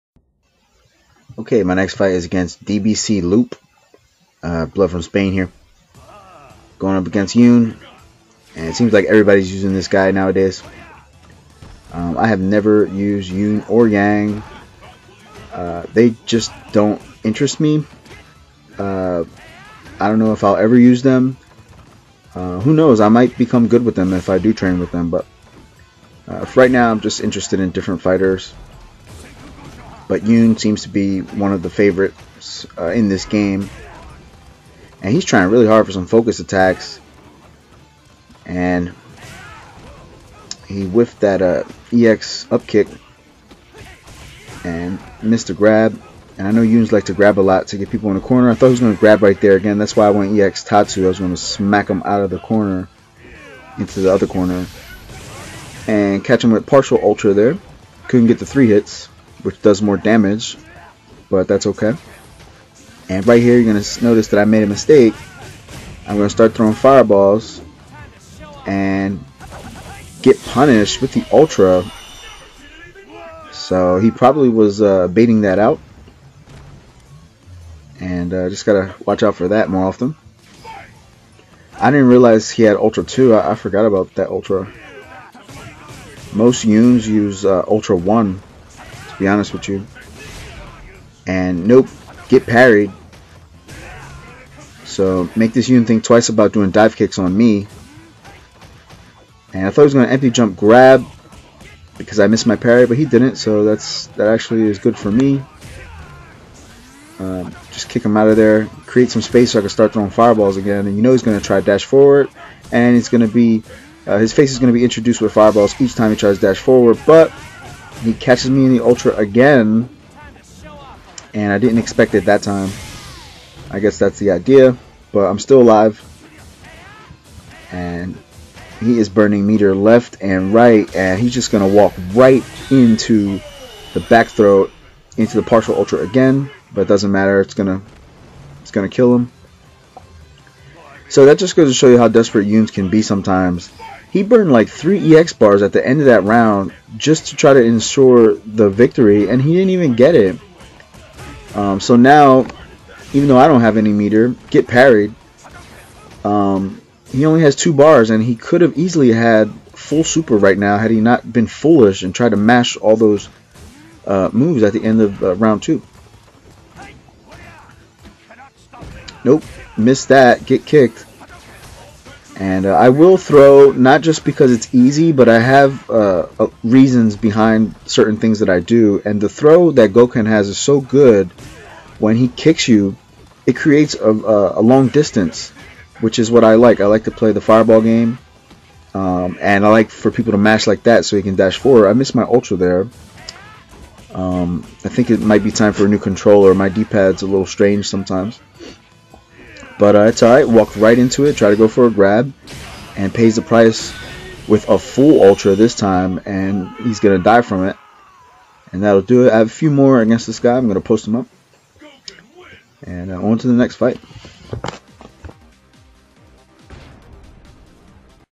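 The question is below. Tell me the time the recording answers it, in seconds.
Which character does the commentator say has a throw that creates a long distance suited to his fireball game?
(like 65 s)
179 s.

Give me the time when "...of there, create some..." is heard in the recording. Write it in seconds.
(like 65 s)
108 s.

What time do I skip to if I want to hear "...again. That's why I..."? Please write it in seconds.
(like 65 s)
49 s.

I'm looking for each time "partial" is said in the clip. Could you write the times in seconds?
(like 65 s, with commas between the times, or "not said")
56 s, 135 s.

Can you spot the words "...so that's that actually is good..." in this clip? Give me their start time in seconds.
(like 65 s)
103 s.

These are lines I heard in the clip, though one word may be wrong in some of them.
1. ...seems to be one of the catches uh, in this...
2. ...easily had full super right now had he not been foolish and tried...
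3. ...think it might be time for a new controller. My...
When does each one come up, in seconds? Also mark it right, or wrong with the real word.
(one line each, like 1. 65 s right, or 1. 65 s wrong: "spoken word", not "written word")
1. 30 s wrong: "favorites", not "catches"
2. 158 s right
3. 194 s right.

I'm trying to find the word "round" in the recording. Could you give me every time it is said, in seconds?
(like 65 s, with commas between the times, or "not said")
146 s, 165 s.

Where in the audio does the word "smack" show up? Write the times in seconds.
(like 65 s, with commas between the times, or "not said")
51 s.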